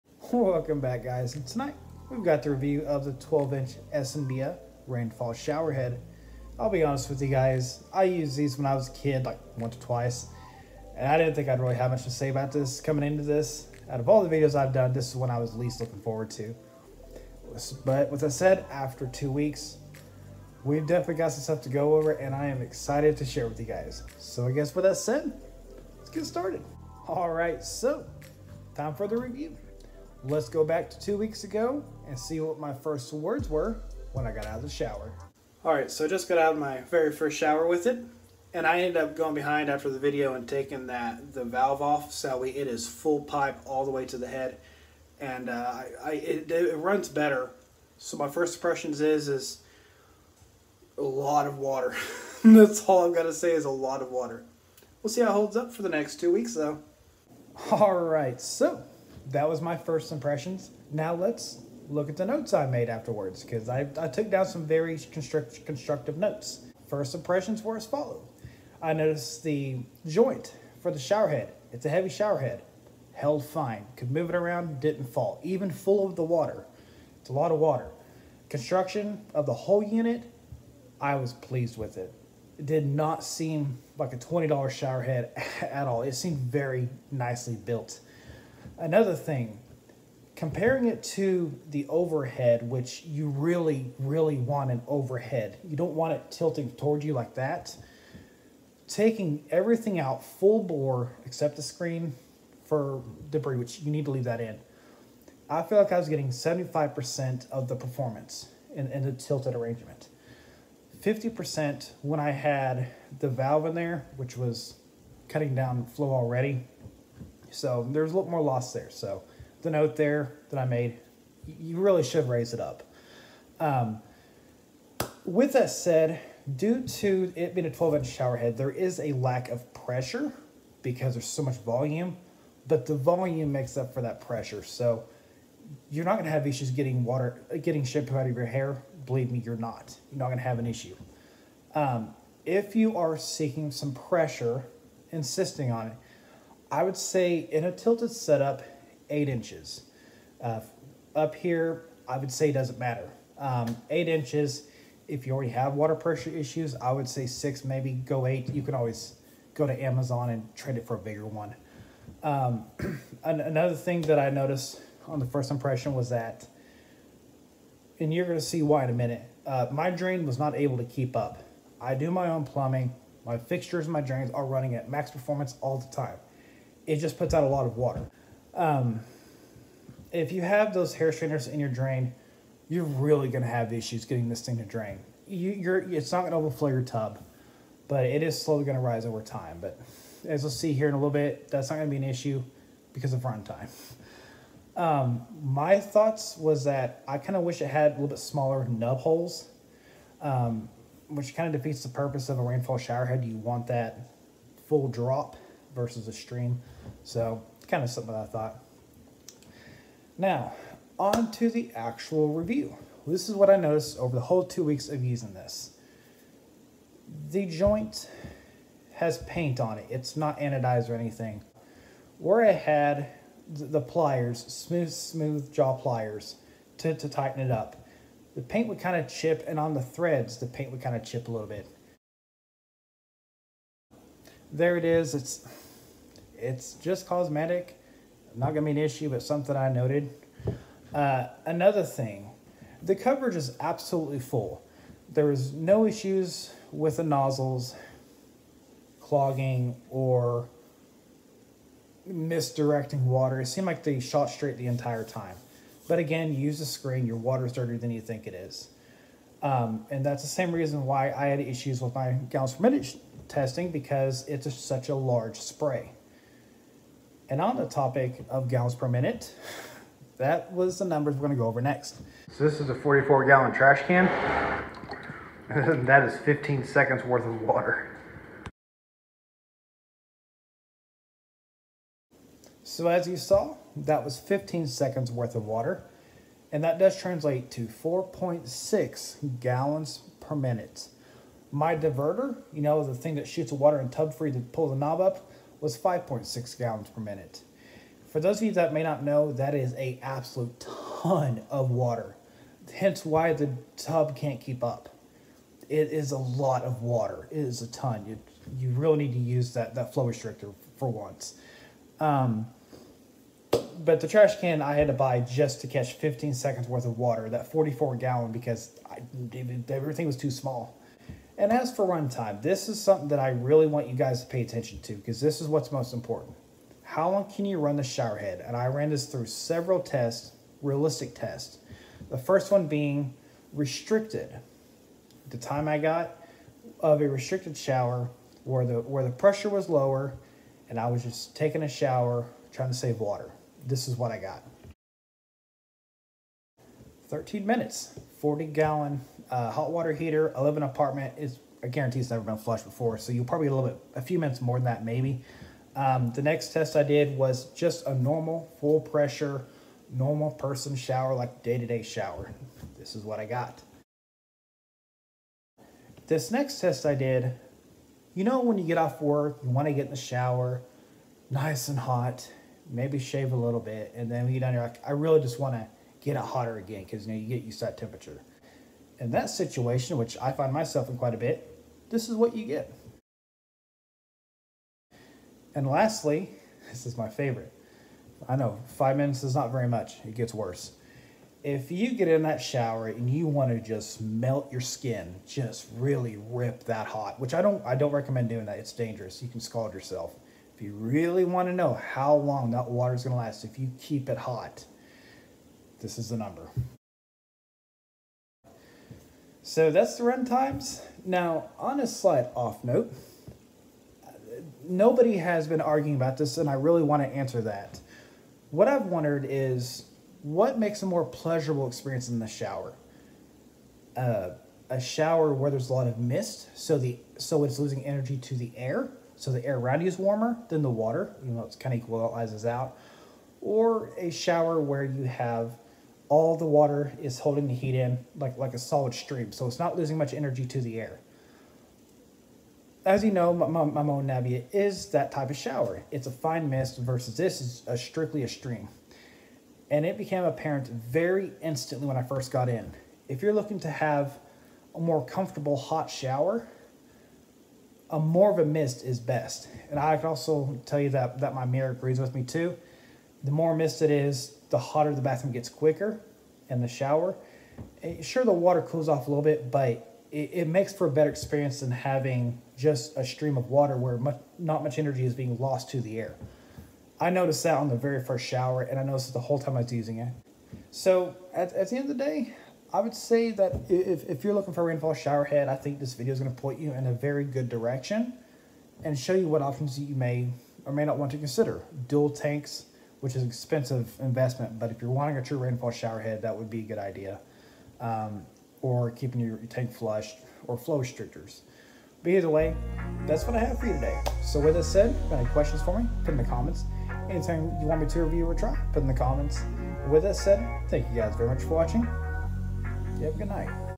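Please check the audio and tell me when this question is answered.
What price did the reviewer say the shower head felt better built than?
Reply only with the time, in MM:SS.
01:24.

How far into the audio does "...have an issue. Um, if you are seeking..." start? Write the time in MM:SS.
02:20.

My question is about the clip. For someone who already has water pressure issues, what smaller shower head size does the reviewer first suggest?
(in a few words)
6 inches.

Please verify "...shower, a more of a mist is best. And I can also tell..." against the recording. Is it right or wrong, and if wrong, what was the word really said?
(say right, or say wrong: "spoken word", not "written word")
right.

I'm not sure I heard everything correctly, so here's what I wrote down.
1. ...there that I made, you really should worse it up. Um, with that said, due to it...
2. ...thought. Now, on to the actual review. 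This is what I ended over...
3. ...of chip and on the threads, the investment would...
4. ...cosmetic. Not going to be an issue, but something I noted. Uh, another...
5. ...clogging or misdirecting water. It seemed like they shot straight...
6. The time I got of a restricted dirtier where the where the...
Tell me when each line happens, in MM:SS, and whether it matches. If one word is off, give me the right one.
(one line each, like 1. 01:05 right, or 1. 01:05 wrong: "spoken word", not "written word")
1. 01:59 wrong: "raise", not "worse"
2. 03:28 wrong: "noticed", not "ended"
3. 03:48 wrong: "paint", not "investment"
4. 03:57 right
5. 04:08 right
6. 05:35 wrong: "shower", not "dirtier".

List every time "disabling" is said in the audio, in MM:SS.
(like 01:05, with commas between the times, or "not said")
not said.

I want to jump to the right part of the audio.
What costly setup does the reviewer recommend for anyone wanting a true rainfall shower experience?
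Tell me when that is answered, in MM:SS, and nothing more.
08:11.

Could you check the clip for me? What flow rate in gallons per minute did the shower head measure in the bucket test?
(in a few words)
4.6.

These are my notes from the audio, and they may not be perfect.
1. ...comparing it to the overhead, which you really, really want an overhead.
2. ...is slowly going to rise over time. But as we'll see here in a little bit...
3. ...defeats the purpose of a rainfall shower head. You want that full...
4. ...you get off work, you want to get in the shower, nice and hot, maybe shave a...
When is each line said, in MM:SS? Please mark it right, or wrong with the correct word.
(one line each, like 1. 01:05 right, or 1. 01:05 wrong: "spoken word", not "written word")
1. 01:30 right
2. 03:08 right
3. 03:21 right
4. 06:08 right.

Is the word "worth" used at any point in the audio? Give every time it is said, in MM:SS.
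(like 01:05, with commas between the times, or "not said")
04:37, 04:45, 05:16.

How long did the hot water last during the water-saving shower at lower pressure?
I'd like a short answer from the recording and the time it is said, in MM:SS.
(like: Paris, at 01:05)
13 minutes, at 05:47.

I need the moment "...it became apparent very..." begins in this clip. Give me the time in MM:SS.
07:29.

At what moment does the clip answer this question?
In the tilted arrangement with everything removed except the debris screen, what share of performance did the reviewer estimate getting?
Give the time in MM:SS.
01:46.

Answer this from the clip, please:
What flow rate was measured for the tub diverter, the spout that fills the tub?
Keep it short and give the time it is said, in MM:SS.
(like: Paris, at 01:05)
5.6 gallons per minute, at 04:55.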